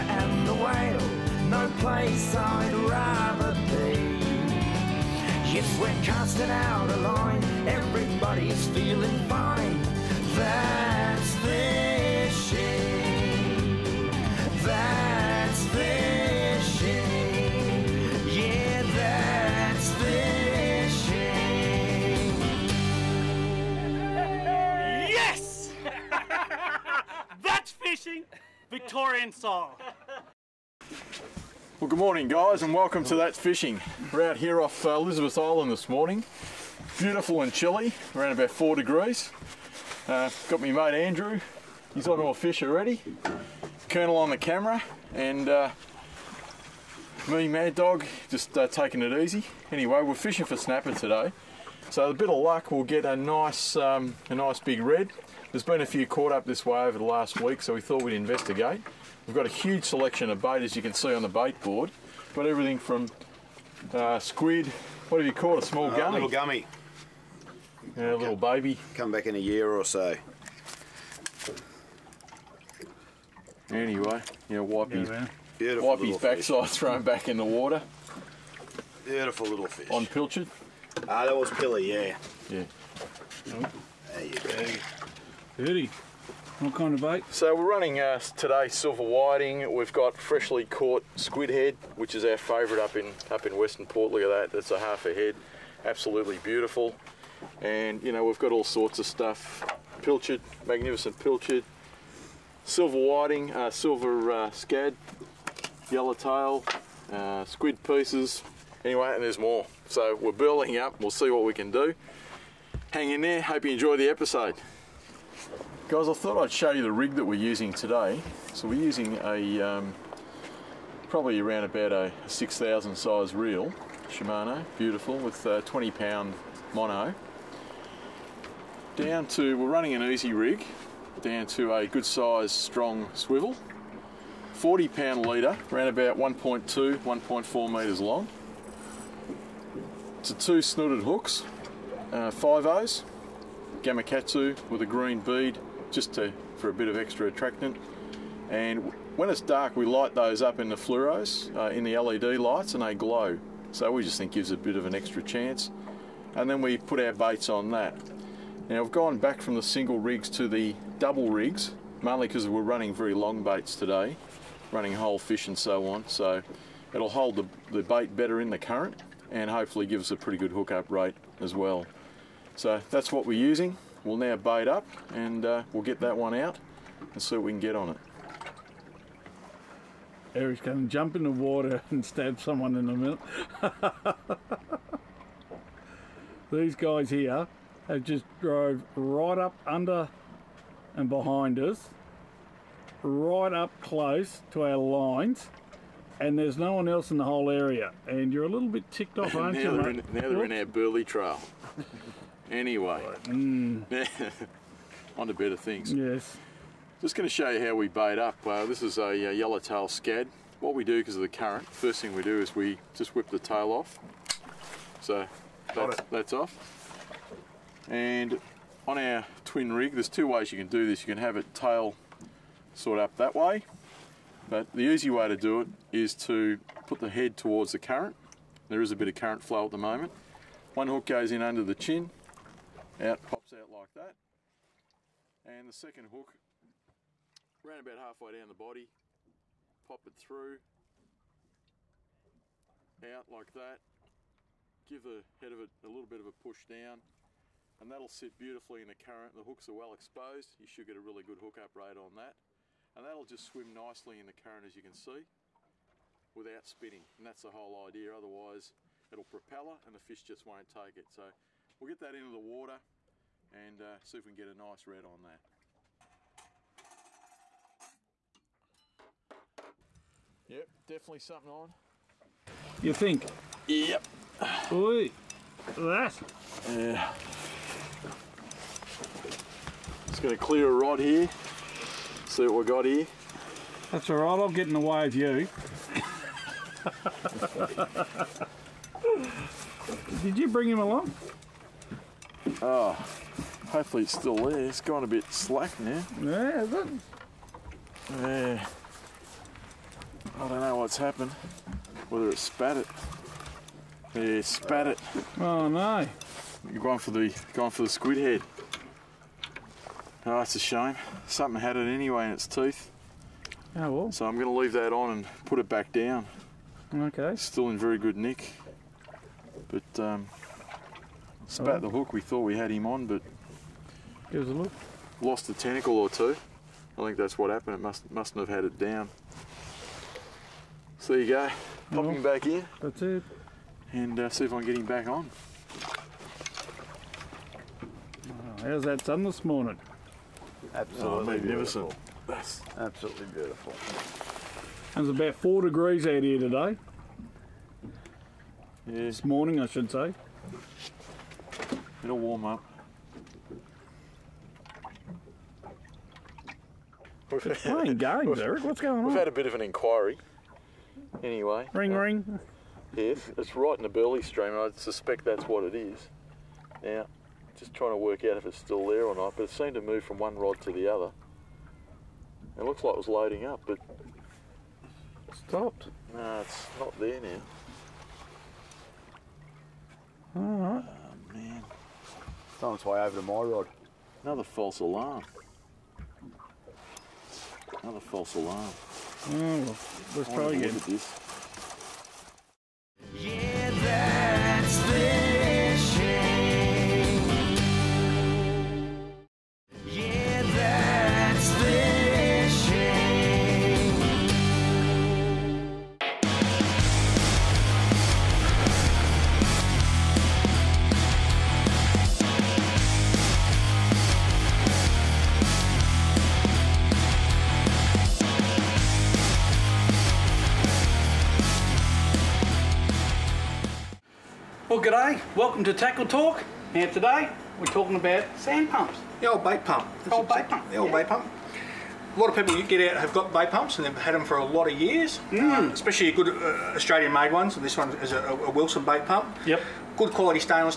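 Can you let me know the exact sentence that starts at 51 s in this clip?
So a bit of luck, we'll get a nice, um, a nice big red.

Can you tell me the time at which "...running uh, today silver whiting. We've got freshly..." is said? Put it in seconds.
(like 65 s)
87 s.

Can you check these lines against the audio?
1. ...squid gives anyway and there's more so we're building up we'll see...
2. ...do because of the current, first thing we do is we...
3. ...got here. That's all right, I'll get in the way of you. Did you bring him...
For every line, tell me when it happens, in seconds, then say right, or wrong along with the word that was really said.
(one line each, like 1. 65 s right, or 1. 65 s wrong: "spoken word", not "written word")
1. 107 s wrong: "pieces", not "gives"
2. 210 s right
3. 282 s right.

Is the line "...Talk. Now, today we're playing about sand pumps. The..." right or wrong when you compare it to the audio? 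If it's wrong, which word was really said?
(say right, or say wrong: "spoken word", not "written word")
wrong: "talking", not "playing".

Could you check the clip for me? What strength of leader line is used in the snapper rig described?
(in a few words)
40 pound.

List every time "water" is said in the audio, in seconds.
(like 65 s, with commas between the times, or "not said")
77 s, 181 s, 262 s.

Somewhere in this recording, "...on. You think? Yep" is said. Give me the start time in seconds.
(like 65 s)
271 s.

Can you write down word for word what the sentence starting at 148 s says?
And when it's dark, we light those up in the fluoros, uh, in the LED lights, and they glow.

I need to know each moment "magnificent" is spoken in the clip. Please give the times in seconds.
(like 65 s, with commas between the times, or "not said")
100 s, 341 s.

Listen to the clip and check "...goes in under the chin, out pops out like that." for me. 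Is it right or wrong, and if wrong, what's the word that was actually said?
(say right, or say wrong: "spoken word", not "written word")
right.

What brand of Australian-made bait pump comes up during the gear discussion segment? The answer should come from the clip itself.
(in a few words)
Wilson.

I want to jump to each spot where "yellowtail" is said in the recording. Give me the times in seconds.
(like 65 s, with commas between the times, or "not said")
105 s, 209 s.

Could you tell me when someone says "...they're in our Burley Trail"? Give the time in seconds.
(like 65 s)
200 s.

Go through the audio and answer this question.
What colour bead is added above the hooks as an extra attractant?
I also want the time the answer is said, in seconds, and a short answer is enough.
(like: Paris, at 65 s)
green, at 144 s.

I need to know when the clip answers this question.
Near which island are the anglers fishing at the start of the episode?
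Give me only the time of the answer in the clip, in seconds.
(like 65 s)
34 s.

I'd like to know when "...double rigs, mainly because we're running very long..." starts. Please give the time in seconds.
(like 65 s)
160 s.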